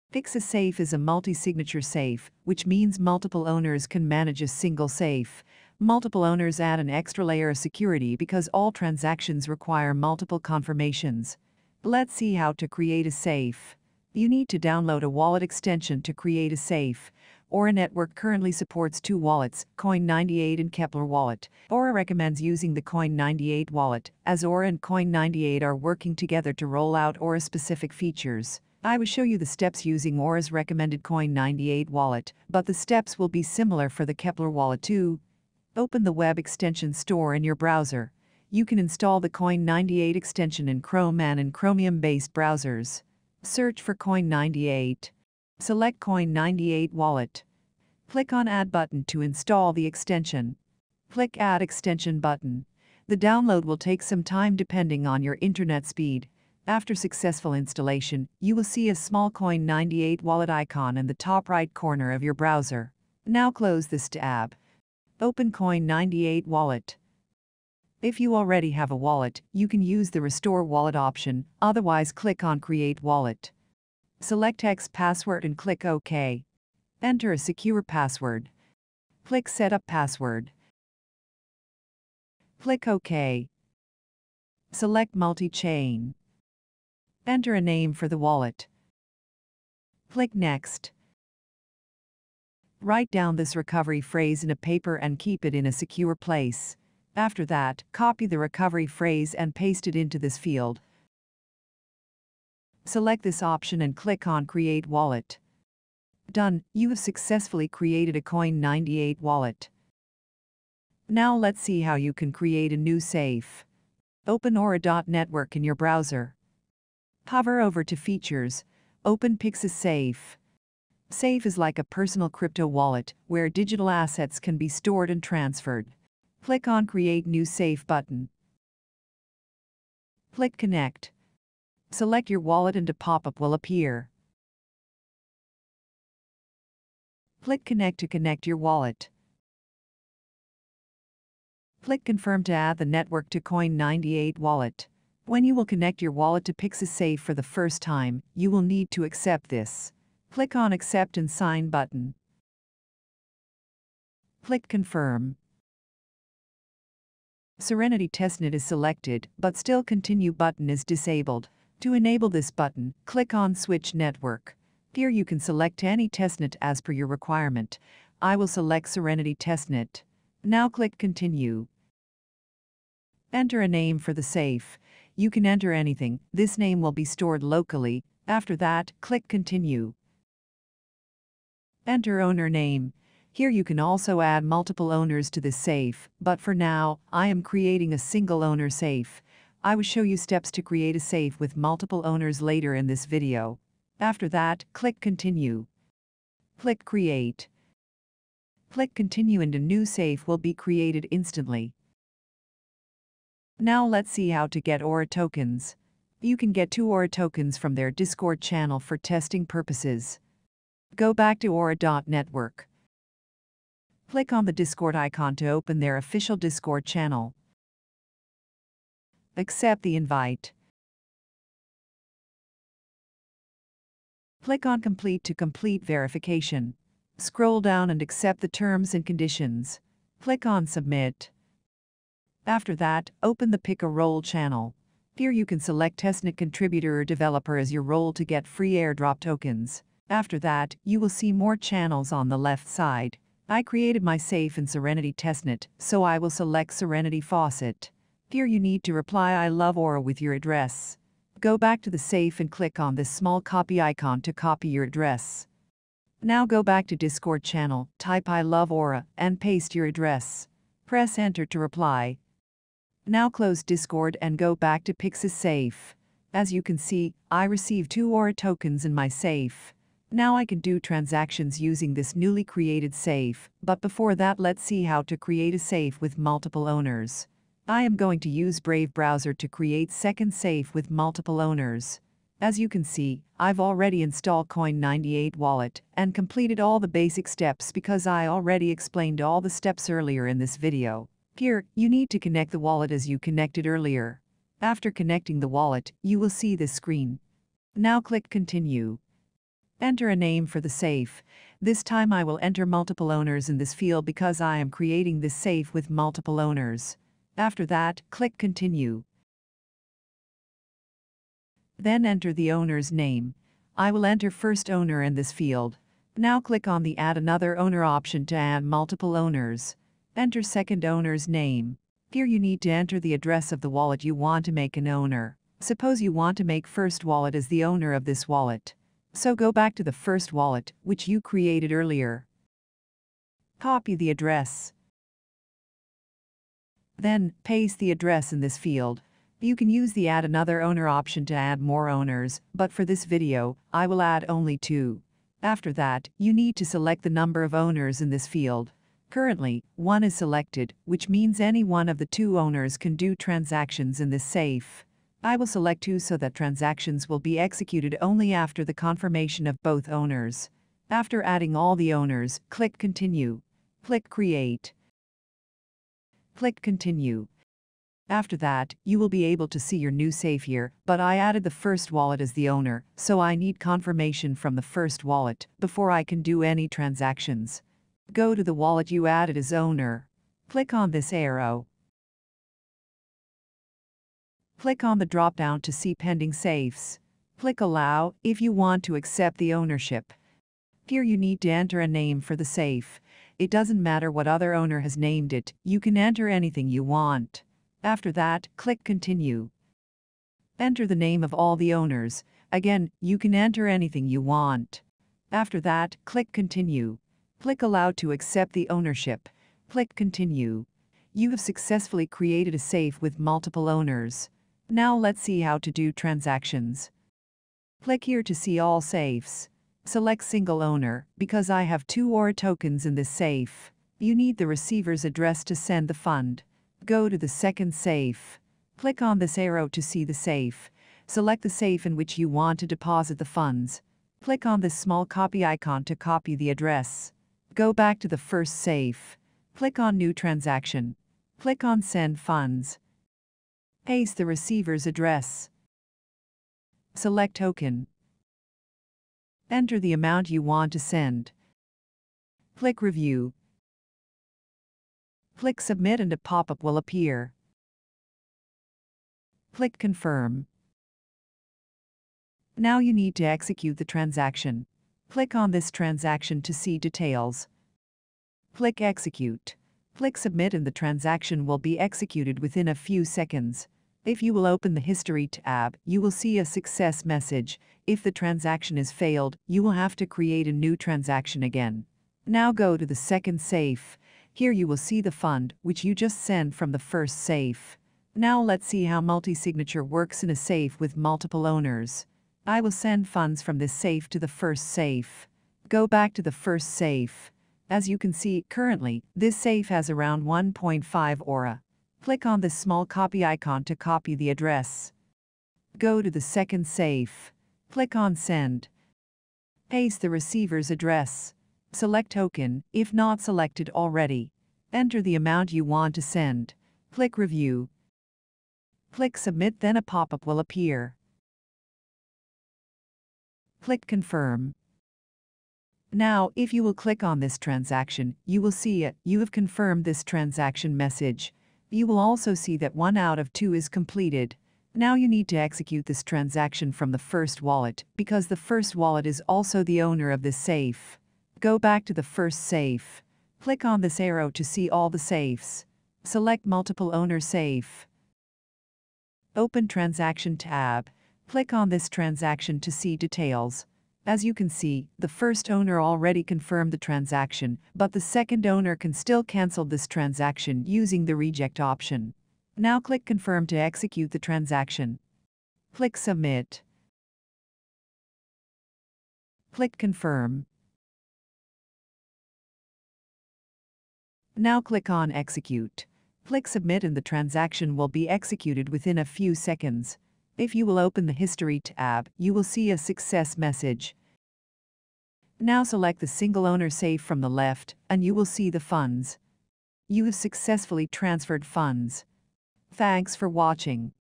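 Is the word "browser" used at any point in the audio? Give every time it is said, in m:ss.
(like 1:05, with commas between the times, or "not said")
0:37, 0:42, 1:02, 1:55, 4:38.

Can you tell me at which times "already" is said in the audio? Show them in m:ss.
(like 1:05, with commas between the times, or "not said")
1:08, 4:43, 4:48, 8:33, 9:15.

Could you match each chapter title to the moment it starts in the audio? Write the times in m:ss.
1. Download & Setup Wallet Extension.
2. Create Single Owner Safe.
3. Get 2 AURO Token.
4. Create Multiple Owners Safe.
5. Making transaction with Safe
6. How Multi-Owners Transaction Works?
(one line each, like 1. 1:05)
1. 0:11
2. 1:51
3. 3:23
4. 4:33
5. 6:54
6. 8:07.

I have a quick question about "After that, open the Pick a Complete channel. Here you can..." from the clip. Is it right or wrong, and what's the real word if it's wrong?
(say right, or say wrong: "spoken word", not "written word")
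wrong: "Role", not "Complete".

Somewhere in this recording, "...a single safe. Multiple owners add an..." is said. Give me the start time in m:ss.
0:04.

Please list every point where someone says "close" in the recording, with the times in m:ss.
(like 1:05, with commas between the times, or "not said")
1:03, 4:23.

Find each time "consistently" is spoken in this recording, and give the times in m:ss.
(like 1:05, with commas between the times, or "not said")
not said.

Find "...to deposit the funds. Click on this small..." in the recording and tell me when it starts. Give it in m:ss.
7:12.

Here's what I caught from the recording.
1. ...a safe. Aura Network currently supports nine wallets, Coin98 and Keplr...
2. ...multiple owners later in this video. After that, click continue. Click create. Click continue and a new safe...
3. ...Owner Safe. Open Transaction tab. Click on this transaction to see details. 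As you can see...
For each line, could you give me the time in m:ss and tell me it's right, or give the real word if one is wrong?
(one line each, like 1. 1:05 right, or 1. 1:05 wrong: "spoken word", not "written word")
1. 0:16 wrong: "two", not "nine"
2. 3:11 right
3. 9:06 right.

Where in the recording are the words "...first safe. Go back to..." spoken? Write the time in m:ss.
8:14.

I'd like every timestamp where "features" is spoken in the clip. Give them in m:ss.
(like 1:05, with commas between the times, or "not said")
0:27, 1:57.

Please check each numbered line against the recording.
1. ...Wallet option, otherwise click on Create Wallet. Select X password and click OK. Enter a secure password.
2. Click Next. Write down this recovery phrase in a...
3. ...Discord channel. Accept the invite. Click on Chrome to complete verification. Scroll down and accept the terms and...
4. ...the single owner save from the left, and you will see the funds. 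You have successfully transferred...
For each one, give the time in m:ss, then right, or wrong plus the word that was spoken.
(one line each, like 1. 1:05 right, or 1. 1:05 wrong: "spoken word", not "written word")
1. 1:10 right
2. 1:30 right
3. 3:36 wrong: "Complete", not "Chrome"
4. 9:45 right.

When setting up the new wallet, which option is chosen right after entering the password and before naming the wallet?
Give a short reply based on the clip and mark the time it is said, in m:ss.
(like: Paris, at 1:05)
Multi-Chain, at 1:25.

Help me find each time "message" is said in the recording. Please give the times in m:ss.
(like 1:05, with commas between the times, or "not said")
7:57, 8:50, 9:43.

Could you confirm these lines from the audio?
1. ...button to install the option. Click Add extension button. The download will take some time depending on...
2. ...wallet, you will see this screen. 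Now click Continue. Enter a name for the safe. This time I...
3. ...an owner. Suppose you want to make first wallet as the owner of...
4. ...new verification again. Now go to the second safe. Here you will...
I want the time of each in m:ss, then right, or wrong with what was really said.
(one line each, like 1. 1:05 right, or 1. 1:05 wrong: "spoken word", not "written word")
1. 0:48 wrong: "extension", not "option"
2. 4:55 right
3. 5:24 right
4. 8:00 wrong: "transaction", not "verification".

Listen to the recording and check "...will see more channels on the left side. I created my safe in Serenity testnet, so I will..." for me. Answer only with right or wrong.
right.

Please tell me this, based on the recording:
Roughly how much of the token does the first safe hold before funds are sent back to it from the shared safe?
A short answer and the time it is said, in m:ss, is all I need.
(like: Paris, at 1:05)
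1.5 aura, at 8:20.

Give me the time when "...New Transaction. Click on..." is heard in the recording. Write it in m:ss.
7:19.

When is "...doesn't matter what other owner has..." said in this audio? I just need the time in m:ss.
6:33.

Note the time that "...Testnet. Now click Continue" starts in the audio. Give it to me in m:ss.
2:49.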